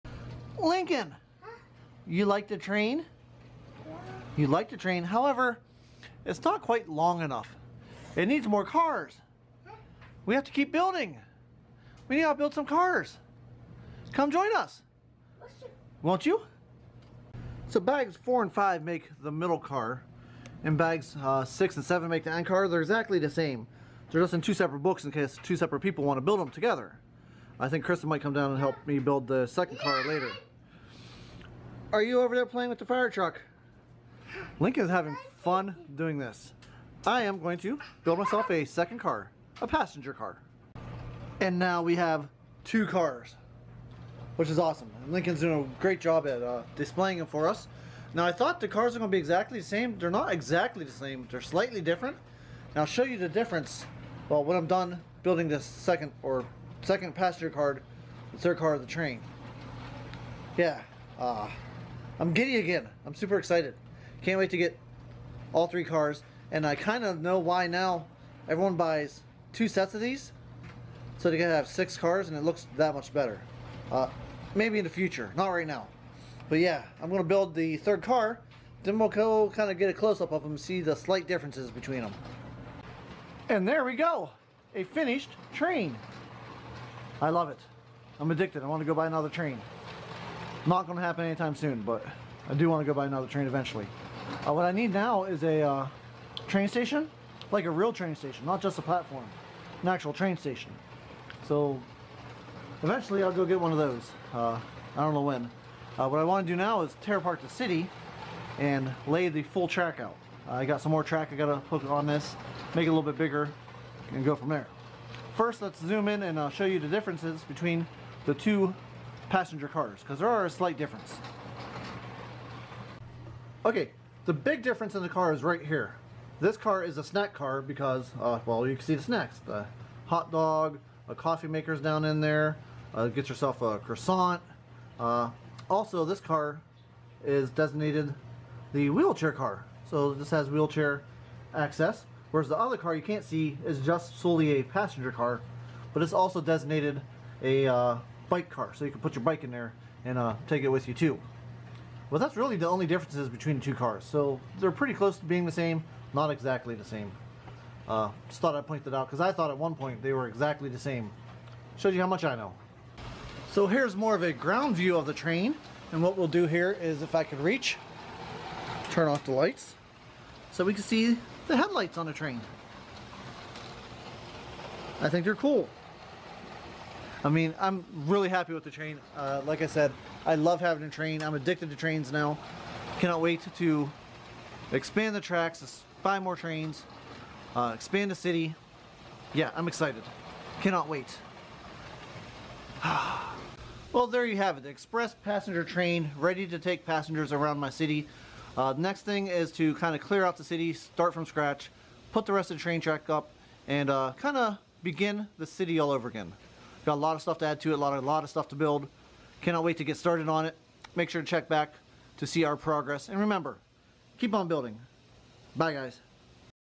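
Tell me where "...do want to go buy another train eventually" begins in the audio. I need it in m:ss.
1:32.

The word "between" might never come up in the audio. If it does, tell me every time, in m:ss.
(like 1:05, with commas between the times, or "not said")
1:21, 1:57, 2:33.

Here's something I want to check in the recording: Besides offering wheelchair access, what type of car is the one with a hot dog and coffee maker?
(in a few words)
Snack car.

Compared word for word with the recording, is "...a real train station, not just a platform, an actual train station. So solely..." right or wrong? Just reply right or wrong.
wrong.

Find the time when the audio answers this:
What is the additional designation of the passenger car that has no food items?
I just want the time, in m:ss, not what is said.
2:28.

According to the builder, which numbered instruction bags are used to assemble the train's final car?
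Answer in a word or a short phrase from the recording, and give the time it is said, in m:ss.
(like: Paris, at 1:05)
6 and 7, at 0:21.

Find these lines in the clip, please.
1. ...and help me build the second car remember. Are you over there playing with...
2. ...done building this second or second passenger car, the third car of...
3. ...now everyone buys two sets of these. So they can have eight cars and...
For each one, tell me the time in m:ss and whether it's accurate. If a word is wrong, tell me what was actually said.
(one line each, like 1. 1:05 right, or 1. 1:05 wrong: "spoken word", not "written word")
1. 0:28 wrong: "later", not "remember"
2. 0:54 right
3. 1:07 wrong: "six", not "eight".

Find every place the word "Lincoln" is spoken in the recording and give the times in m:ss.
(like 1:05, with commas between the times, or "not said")
0:00, 0:45.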